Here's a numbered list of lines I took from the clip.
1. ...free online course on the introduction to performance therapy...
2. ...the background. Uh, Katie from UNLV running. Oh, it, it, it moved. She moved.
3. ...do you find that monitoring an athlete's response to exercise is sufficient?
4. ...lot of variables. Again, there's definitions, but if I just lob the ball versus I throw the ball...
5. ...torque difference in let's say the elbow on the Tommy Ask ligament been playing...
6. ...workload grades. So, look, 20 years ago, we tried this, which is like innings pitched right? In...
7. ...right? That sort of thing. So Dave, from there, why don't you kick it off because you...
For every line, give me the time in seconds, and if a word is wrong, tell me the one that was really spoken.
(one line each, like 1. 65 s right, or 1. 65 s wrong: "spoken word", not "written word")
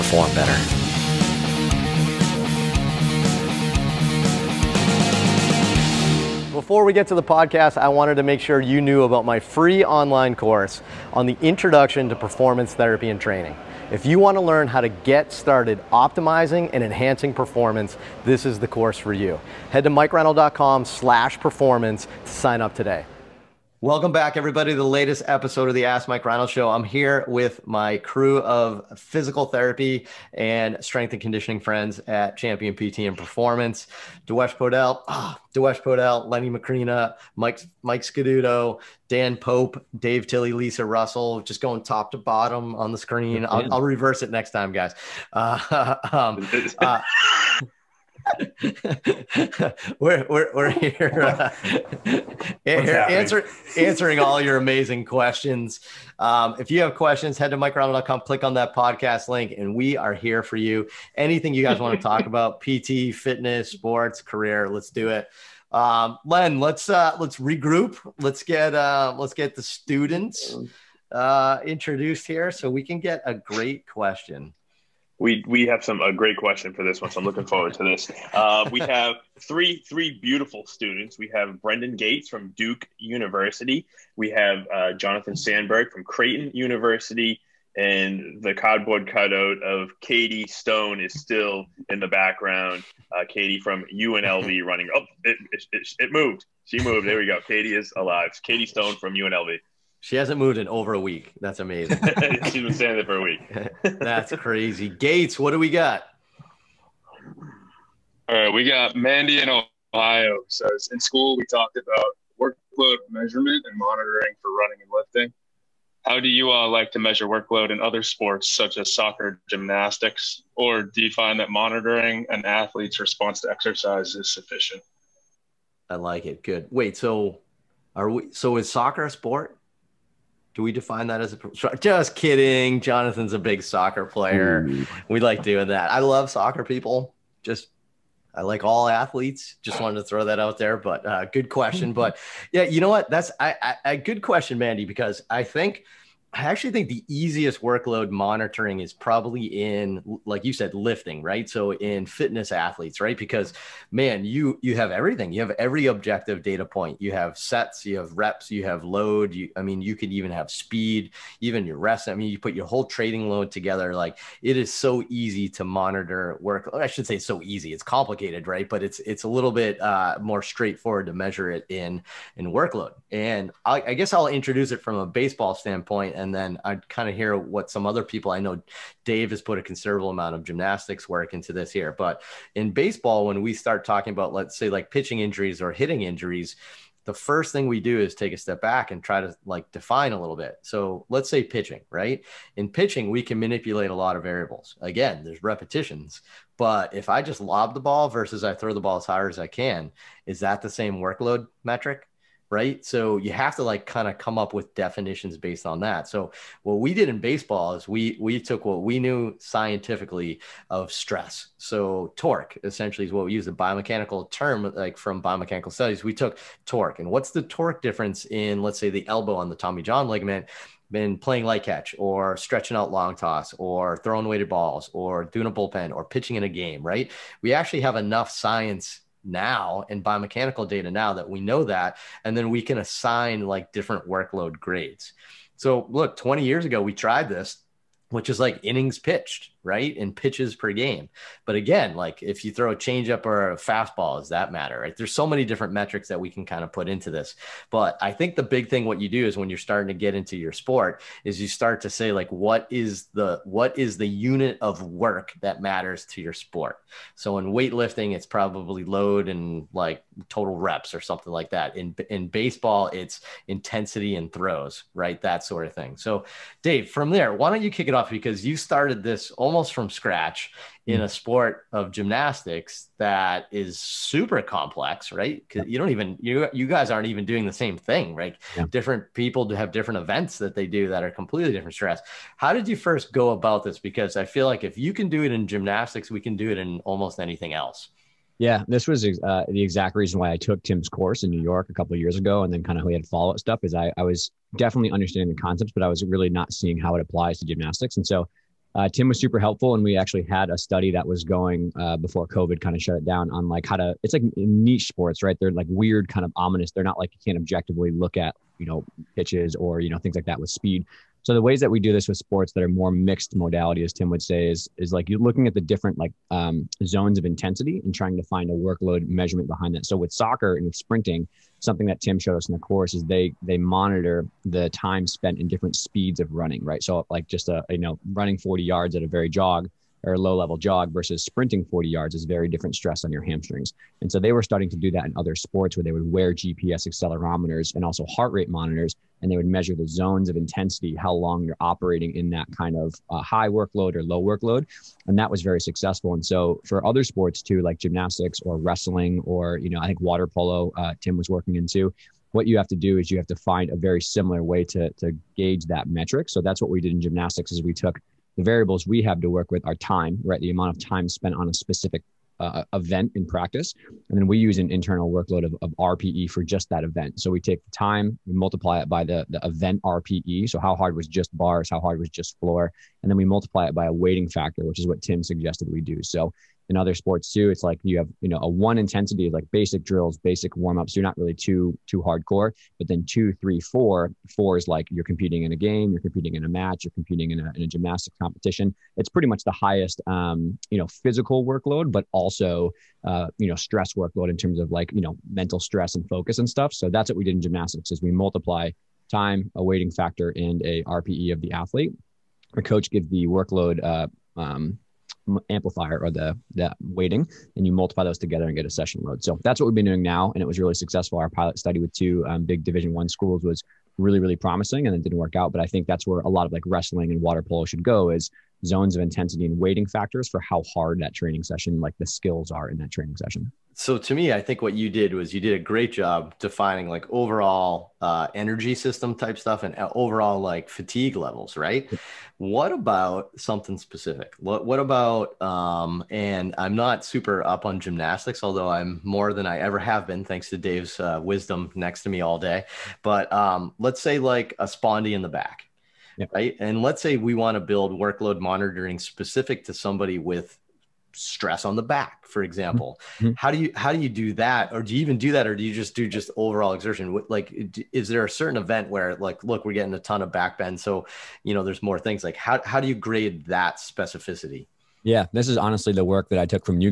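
1. 9 s right
2. 91 s right
3. 120 s right
4. 193 s wrong: "repetitions", not "definitions"
5. 217 s wrong: "John", not "Ask"
6. 234 s right
7. 264 s right.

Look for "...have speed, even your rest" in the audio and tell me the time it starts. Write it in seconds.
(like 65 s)
160 s.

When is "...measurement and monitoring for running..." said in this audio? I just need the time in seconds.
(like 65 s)
113 s.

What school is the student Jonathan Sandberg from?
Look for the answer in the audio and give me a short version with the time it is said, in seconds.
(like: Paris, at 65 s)
Creighton University, at 86 s.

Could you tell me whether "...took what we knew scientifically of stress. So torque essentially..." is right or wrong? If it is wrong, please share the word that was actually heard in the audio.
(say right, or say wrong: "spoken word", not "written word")
right.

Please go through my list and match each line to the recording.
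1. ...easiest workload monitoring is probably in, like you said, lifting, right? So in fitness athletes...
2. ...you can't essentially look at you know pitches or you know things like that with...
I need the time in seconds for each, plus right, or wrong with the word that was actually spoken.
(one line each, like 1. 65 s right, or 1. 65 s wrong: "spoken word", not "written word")
1. 147 s right
2. 307 s wrong: "objectively", not "essentially".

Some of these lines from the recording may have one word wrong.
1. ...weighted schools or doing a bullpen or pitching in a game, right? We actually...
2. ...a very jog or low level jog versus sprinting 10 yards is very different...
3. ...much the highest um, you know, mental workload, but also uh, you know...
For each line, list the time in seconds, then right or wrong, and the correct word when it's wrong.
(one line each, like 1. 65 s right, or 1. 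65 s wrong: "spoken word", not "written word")
1. 224 s wrong: "balls", not "schools"
2. 329 s wrong: "40", not "10"
3. 389 s wrong: "physical", not "mental".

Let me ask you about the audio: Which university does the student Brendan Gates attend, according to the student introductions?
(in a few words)
Duke University.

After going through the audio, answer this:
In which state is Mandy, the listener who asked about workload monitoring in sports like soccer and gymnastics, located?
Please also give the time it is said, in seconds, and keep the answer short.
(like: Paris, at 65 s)
Ohio, at 109 s.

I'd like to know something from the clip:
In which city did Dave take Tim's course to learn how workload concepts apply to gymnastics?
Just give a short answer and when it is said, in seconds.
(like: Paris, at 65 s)
New York, at 291 s.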